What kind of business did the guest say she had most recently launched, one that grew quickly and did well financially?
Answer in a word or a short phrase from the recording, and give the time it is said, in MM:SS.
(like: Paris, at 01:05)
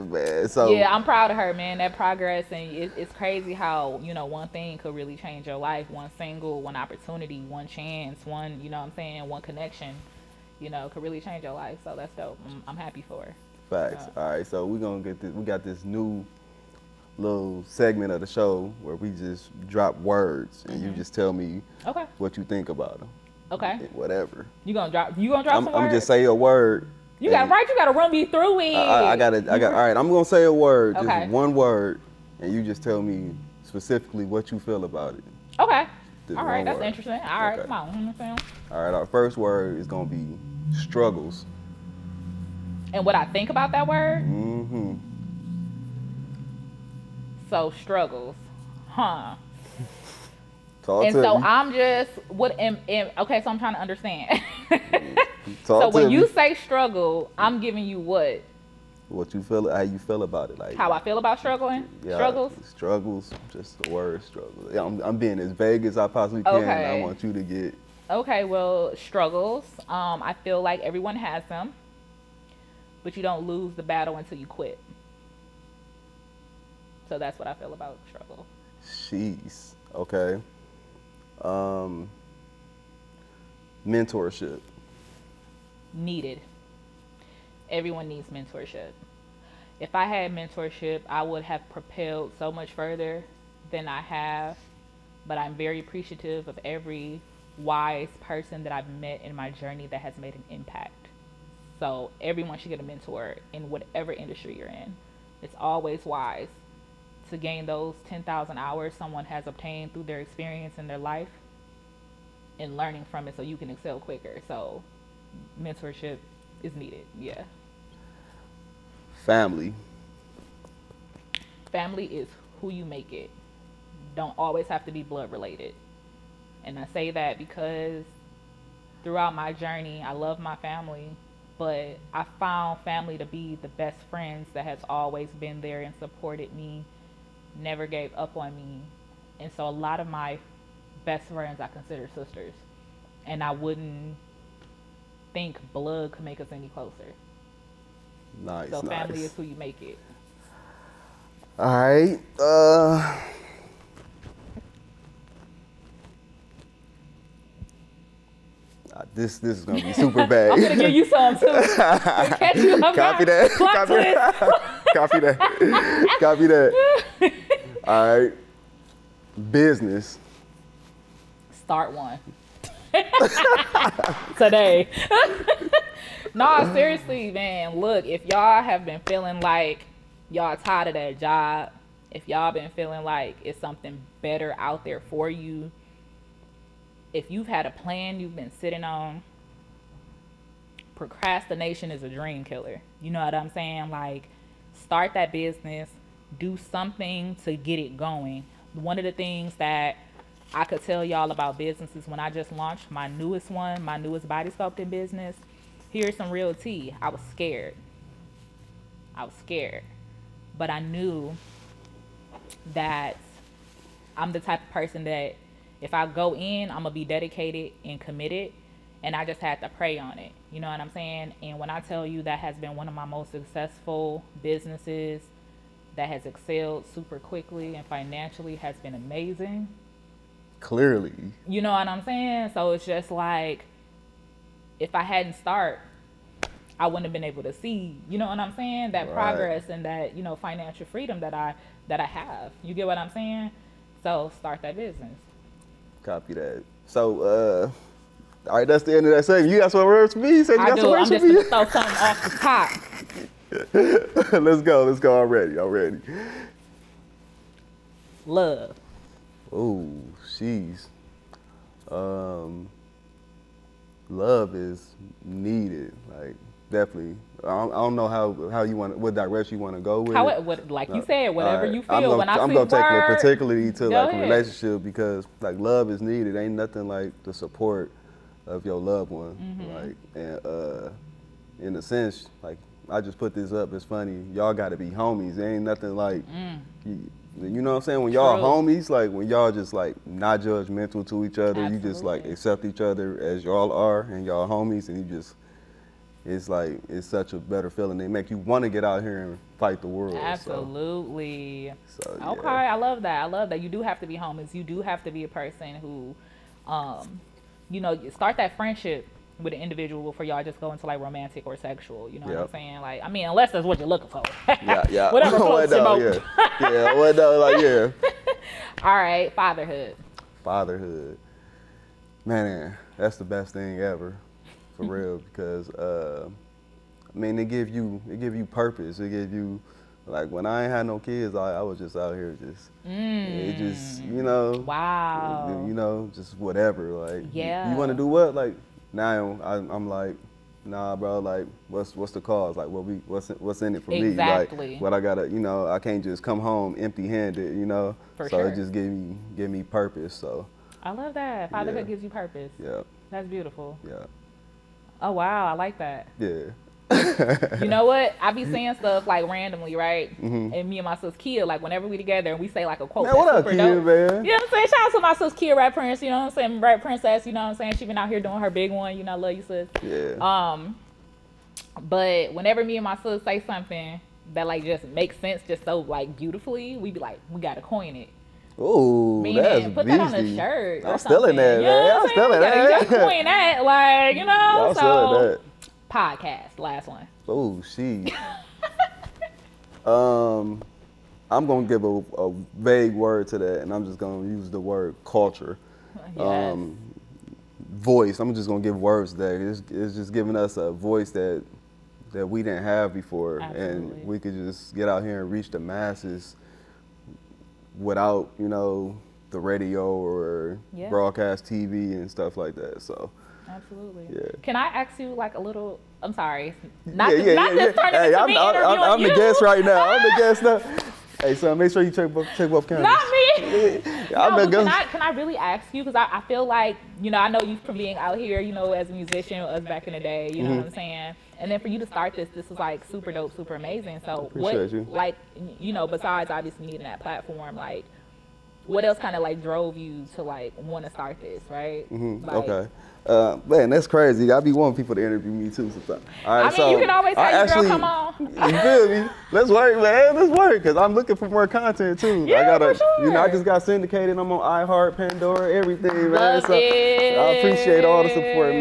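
Body sculpting, at 03:24.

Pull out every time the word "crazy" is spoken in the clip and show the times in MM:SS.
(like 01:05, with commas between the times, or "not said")
00:03, 07:23.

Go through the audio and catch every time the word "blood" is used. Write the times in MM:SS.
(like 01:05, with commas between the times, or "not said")
02:05, 02:25.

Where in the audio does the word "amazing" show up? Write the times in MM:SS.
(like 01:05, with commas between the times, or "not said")
03:48, 07:13.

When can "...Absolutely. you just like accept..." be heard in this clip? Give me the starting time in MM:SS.
04:51.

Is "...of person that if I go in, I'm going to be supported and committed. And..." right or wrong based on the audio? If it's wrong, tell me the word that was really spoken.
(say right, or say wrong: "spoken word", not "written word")
wrong: "dedicated", not "supported".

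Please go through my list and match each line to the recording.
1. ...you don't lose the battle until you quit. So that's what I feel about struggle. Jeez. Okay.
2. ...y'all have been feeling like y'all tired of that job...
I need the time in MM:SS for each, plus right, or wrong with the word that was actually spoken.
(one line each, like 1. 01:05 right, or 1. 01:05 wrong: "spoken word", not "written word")
1. 01:13 right
2. 02:58 right.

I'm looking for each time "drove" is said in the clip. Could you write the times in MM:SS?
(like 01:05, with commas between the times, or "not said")
07:19.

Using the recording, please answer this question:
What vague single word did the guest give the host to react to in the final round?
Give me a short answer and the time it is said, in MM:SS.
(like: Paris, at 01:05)
Culture, at 06:35.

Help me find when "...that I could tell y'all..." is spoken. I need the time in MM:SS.
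03:19.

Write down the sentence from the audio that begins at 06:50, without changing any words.
broadcast TV and stuff like that.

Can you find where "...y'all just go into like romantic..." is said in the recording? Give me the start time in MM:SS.
05:10.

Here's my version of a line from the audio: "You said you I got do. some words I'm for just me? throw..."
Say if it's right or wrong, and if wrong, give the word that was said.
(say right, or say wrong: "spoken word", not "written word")
right.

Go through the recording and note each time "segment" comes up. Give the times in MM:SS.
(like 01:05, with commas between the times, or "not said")
00:17, 04:09.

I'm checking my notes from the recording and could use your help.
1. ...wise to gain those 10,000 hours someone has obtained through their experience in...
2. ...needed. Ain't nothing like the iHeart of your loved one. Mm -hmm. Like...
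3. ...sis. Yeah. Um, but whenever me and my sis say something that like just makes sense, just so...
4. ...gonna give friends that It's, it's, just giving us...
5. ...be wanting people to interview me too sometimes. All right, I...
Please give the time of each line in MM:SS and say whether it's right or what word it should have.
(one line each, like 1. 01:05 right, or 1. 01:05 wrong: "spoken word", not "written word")
1. 01:46 right
2. 04:36 wrong: "support", not "iHeart"
3. 06:09 right
4. 06:38 wrong: "words", not "friends"
5. 07:24 right.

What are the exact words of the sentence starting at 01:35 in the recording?
But I'm very appreciative of every wise person that I've met in my journey that has made an impact.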